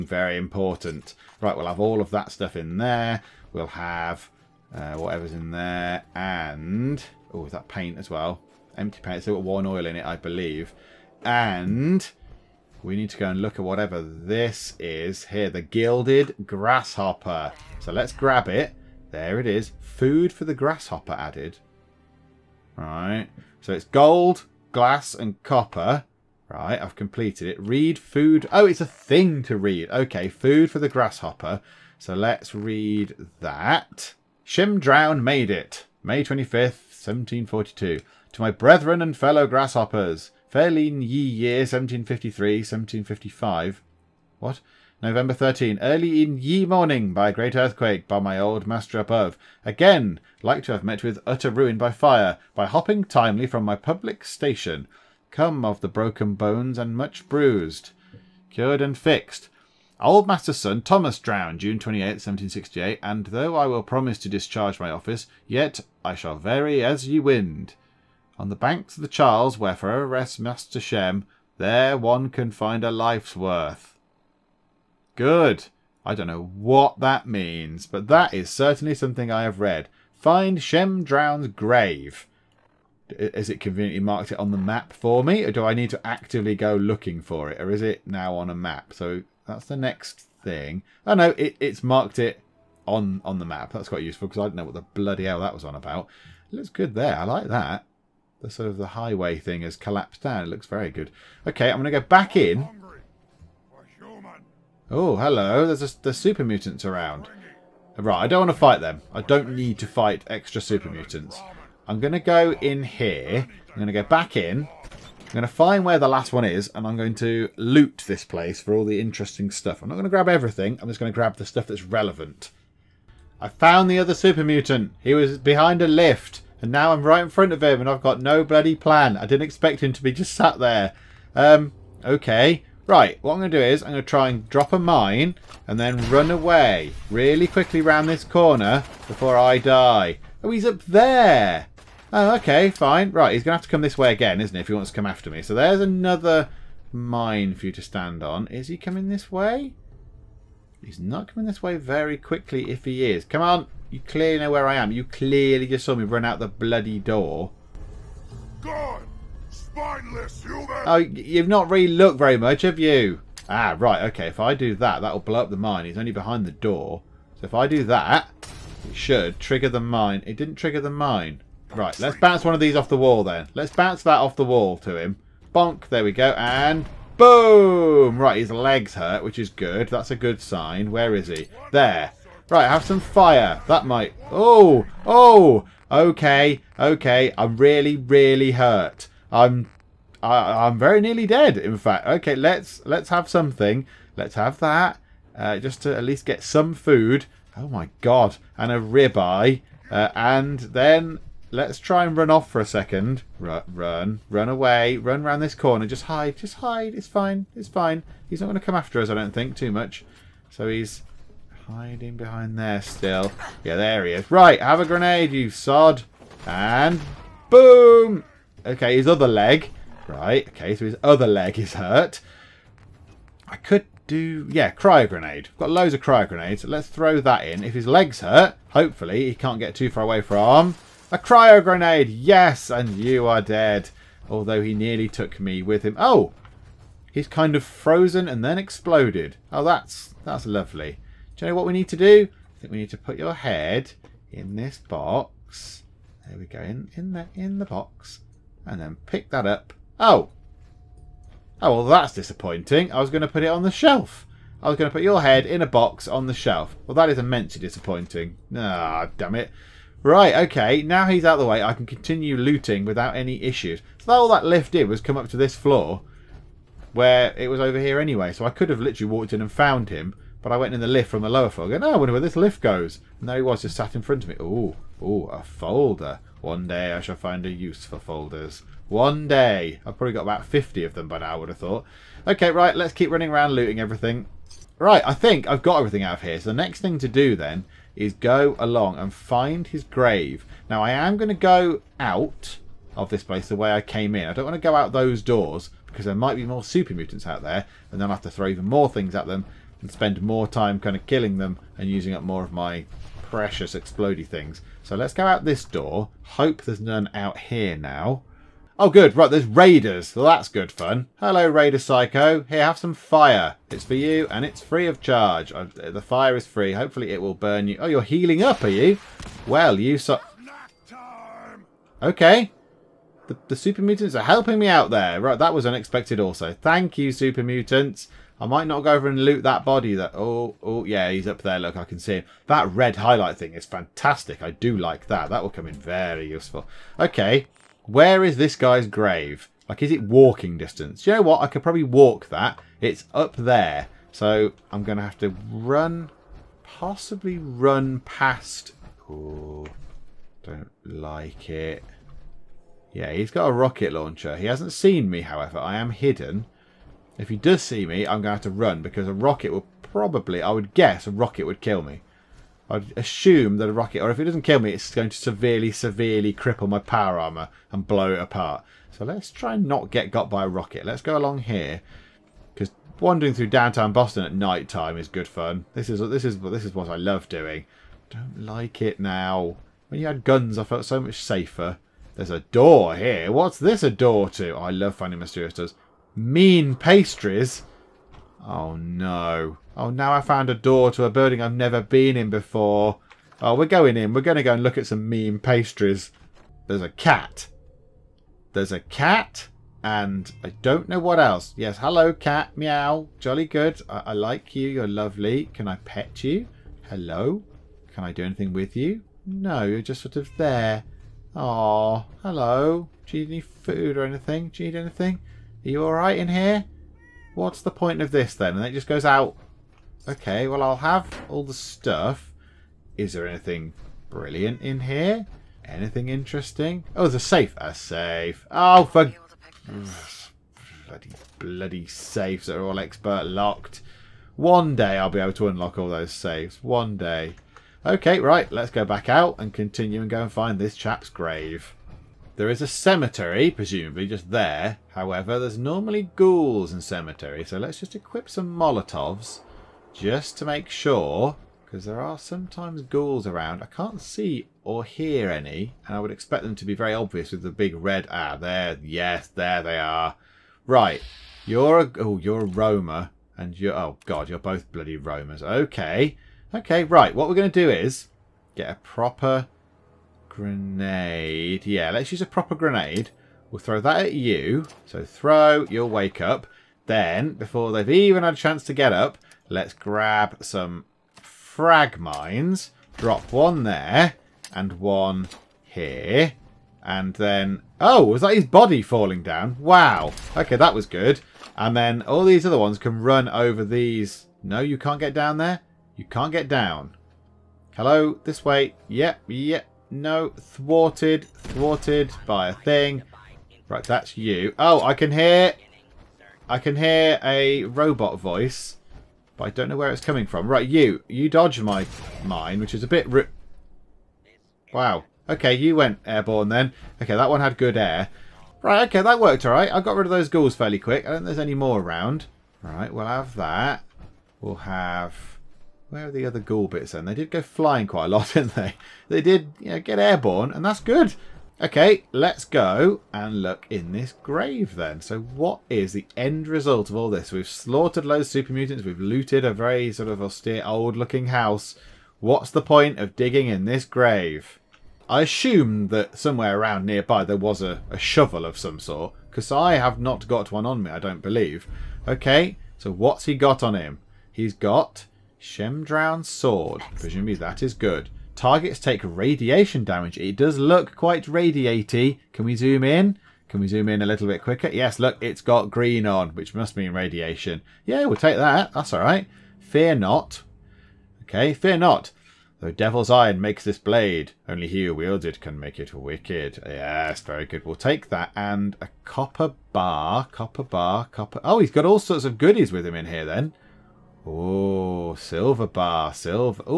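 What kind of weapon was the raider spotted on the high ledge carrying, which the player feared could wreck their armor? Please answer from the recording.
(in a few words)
rocket launcher.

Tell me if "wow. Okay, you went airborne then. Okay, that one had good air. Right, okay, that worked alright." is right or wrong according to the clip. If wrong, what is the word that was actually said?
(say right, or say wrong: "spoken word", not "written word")
right.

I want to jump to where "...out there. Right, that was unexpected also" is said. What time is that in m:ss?
5:24.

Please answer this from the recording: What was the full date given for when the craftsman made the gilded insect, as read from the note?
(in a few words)
May 25th, 1742.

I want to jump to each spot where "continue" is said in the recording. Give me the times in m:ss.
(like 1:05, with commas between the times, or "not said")
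4:21, 7:19.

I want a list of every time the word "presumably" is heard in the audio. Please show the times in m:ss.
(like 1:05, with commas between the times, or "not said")
7:23, 9:16.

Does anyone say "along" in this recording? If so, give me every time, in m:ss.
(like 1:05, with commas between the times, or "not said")
4:48, 6:11.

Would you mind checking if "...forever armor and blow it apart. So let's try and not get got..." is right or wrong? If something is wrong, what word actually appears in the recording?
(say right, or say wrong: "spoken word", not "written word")
wrong: "power", not "forever".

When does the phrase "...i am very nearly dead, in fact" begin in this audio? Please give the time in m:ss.
3:10.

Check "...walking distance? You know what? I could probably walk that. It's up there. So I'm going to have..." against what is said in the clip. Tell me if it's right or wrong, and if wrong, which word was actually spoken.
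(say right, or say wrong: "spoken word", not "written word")
right.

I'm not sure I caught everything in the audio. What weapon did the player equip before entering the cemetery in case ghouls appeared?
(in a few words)
Molotovs.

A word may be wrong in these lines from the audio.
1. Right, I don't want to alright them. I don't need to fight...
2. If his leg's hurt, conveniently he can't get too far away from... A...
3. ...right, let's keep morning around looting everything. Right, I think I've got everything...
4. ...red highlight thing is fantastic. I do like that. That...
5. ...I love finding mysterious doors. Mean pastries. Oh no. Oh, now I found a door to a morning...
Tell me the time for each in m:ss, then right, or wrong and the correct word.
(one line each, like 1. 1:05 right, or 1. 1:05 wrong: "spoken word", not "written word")
1. 1:47 wrong: "fight", not "alright"
2. 3:47 wrong: "hopefully", not "conveniently"
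3. 4:42 wrong: "running", not "morning"
4. 5:32 right
5. 6:24 wrong: "building", not "morning".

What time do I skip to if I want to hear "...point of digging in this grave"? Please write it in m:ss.
9:02.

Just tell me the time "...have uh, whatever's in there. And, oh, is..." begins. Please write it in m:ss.
0:03.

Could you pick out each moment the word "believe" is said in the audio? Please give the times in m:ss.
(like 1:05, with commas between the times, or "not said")
0:10, 9:11.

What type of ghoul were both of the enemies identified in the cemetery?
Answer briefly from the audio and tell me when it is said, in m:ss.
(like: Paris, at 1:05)
Roamers, at 7:44.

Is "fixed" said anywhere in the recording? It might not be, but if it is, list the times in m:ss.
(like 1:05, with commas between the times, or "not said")
0:58.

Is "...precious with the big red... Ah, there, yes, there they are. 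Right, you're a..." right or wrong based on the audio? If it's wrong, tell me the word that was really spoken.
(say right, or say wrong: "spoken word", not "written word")
wrong: "obvious", not "precious".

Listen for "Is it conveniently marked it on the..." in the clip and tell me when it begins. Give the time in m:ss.
1:23.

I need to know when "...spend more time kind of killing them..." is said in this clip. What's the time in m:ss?
4:59.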